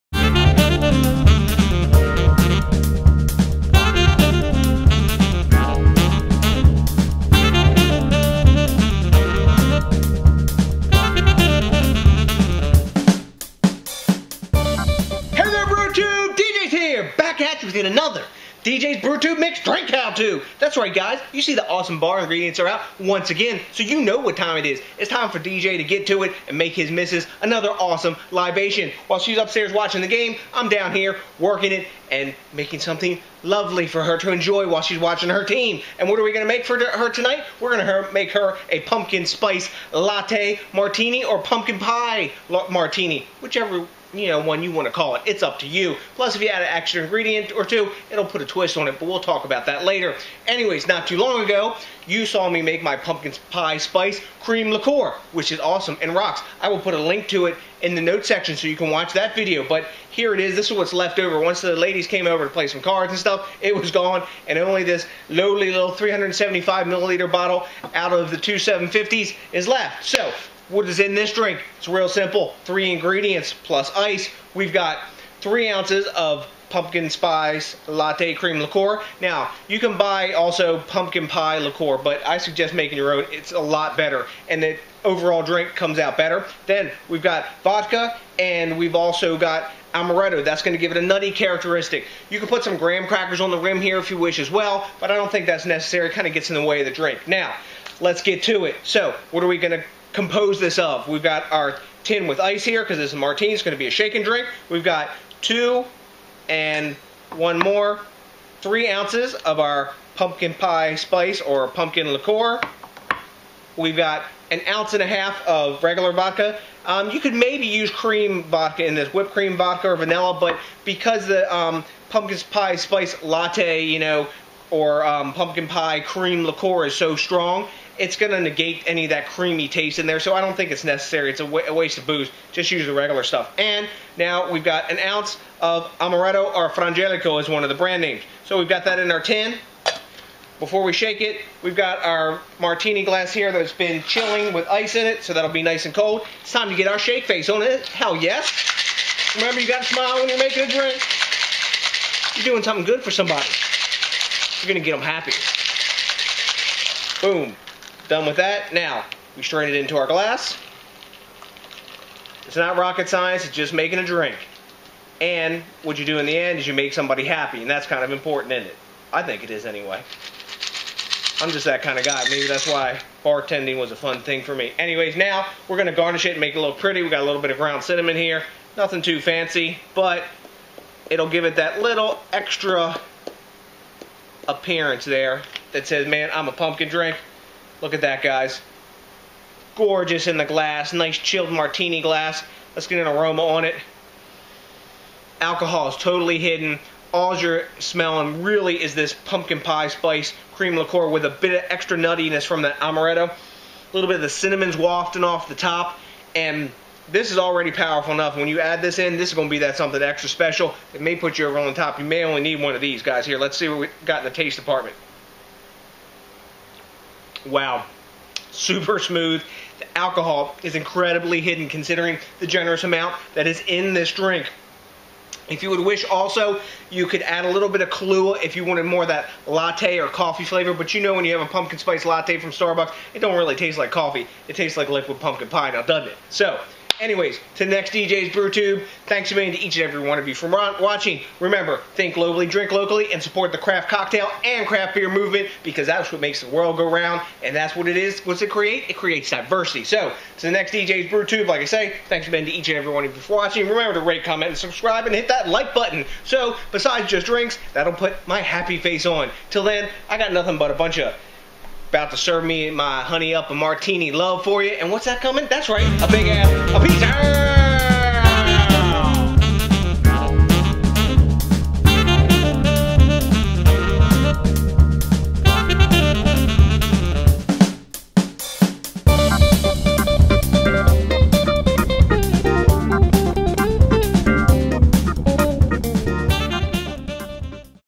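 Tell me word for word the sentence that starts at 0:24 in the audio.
It's time for DJ to get to it and make his missus another awesome libation.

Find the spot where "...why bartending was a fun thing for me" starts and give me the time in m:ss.
2:52.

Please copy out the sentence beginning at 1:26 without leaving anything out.
Then we've got vodka, and we've also got amaretto.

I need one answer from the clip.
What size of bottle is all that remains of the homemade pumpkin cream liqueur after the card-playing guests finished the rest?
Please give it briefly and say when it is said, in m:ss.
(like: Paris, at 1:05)
375 milliliters, at 1:05.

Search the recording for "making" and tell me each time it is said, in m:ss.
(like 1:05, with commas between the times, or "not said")
0:32, 1:22, 2:30, 2:43.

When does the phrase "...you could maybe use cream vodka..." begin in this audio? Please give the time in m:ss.
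1:57.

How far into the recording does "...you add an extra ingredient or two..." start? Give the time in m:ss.
0:46.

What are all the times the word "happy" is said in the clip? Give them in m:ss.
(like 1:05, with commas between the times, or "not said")
2:35, 2:47, 4:18.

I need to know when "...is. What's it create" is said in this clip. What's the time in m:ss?
4:07.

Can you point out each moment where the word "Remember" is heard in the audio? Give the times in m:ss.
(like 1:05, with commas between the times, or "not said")
2:29, 4:01, 4:13.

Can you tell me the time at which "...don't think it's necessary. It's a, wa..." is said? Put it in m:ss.
2:10.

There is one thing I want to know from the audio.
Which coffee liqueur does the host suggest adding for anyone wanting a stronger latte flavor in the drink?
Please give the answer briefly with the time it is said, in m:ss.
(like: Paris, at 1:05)
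Kahlua, at 3:47.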